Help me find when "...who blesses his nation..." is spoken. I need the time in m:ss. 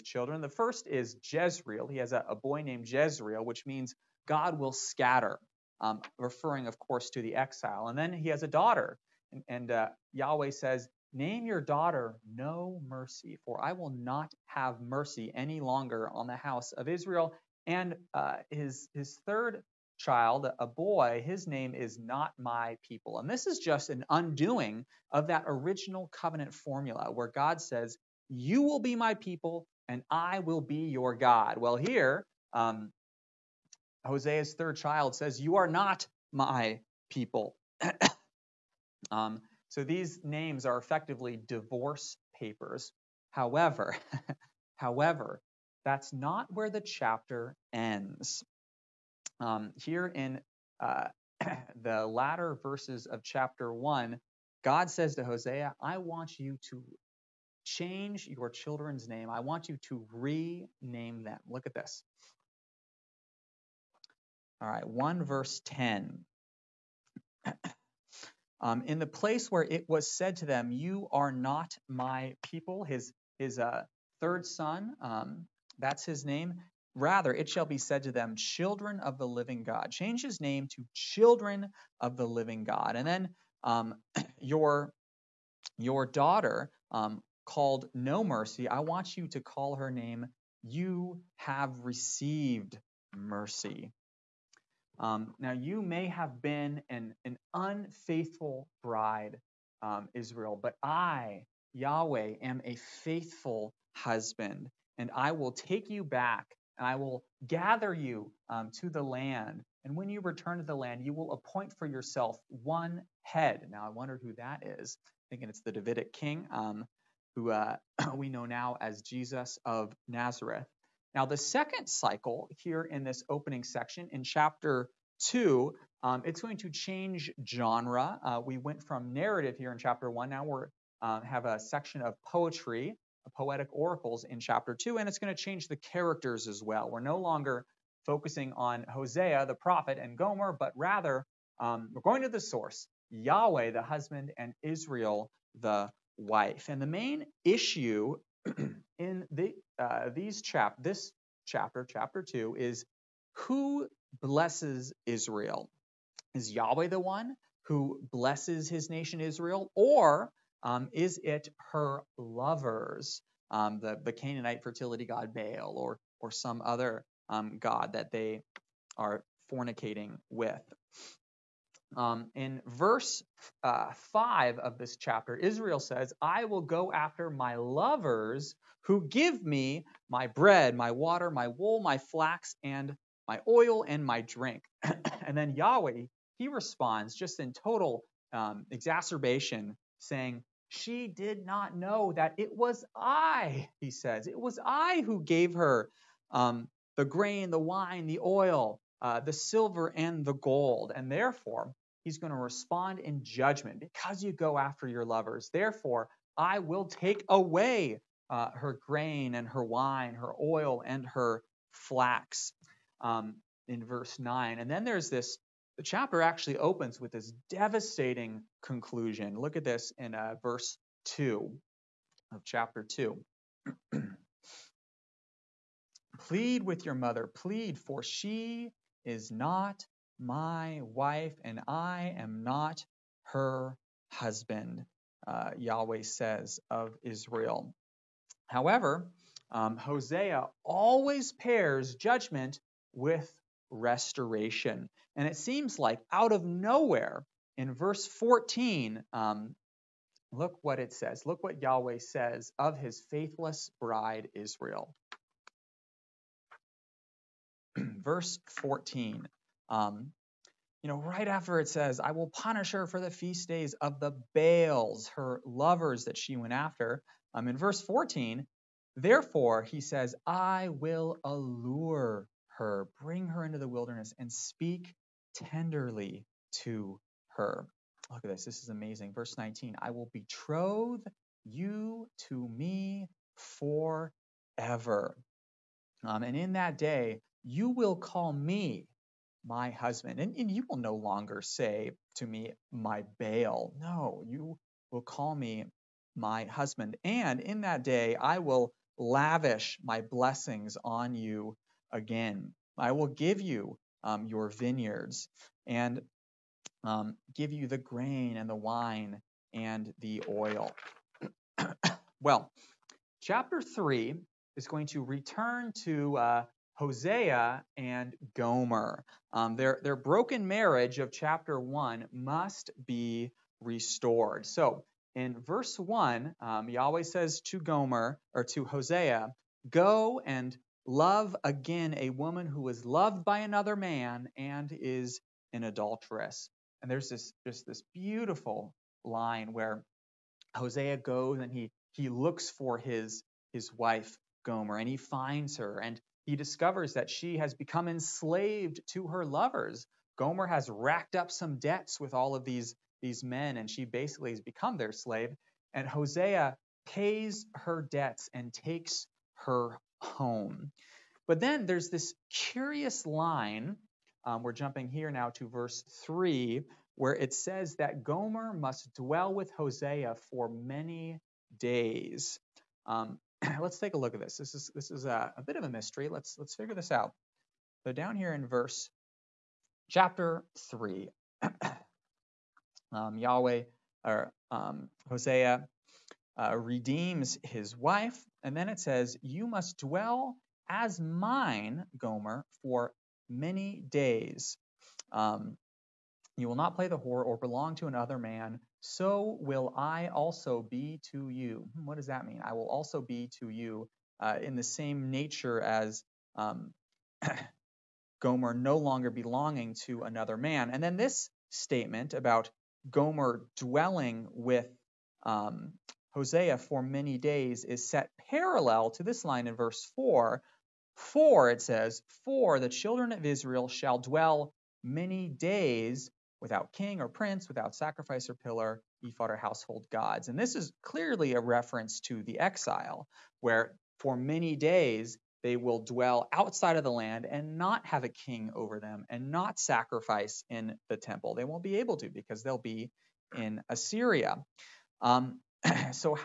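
2:37.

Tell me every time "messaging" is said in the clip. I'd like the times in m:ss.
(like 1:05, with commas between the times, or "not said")
not said.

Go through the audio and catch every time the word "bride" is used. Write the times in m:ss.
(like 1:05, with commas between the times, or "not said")
1:38, 4:13.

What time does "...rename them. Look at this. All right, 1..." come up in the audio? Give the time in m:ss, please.
1:00.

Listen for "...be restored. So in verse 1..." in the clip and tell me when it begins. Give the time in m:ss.
5:22.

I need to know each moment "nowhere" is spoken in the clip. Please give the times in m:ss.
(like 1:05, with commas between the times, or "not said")
4:06.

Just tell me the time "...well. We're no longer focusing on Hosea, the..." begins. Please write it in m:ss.
2:16.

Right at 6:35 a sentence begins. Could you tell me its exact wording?
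Um, you will not play the whore or belong to another man.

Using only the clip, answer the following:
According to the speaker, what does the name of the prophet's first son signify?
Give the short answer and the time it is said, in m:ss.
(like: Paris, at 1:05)
God will scatter, at 0:04.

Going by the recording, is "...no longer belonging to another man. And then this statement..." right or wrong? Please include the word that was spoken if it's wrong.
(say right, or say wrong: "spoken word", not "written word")
right.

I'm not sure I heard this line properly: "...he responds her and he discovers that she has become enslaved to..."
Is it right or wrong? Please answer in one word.
wrong.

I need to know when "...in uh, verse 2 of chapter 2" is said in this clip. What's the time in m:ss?
3:39.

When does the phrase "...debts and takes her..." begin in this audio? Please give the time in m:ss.
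5:57.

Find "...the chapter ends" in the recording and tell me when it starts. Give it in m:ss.
0:46.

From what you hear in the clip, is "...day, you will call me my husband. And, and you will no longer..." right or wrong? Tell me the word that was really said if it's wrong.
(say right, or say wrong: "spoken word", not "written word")
right.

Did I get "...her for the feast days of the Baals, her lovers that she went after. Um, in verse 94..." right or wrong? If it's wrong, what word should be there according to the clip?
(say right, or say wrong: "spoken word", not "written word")
wrong: "14", not "94".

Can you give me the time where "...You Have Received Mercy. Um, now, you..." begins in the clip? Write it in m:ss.
1:30.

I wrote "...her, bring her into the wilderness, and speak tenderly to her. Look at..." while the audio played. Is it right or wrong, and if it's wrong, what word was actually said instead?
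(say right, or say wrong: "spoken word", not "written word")
right.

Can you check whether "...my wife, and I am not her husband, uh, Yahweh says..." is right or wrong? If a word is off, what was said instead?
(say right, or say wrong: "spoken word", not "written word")
right.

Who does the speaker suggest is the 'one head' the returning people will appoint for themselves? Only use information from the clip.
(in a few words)
The Davidic king.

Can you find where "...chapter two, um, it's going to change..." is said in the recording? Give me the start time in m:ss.
2:04.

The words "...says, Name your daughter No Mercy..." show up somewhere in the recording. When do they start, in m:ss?
0:10.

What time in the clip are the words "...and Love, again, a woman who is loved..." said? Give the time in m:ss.
5:30.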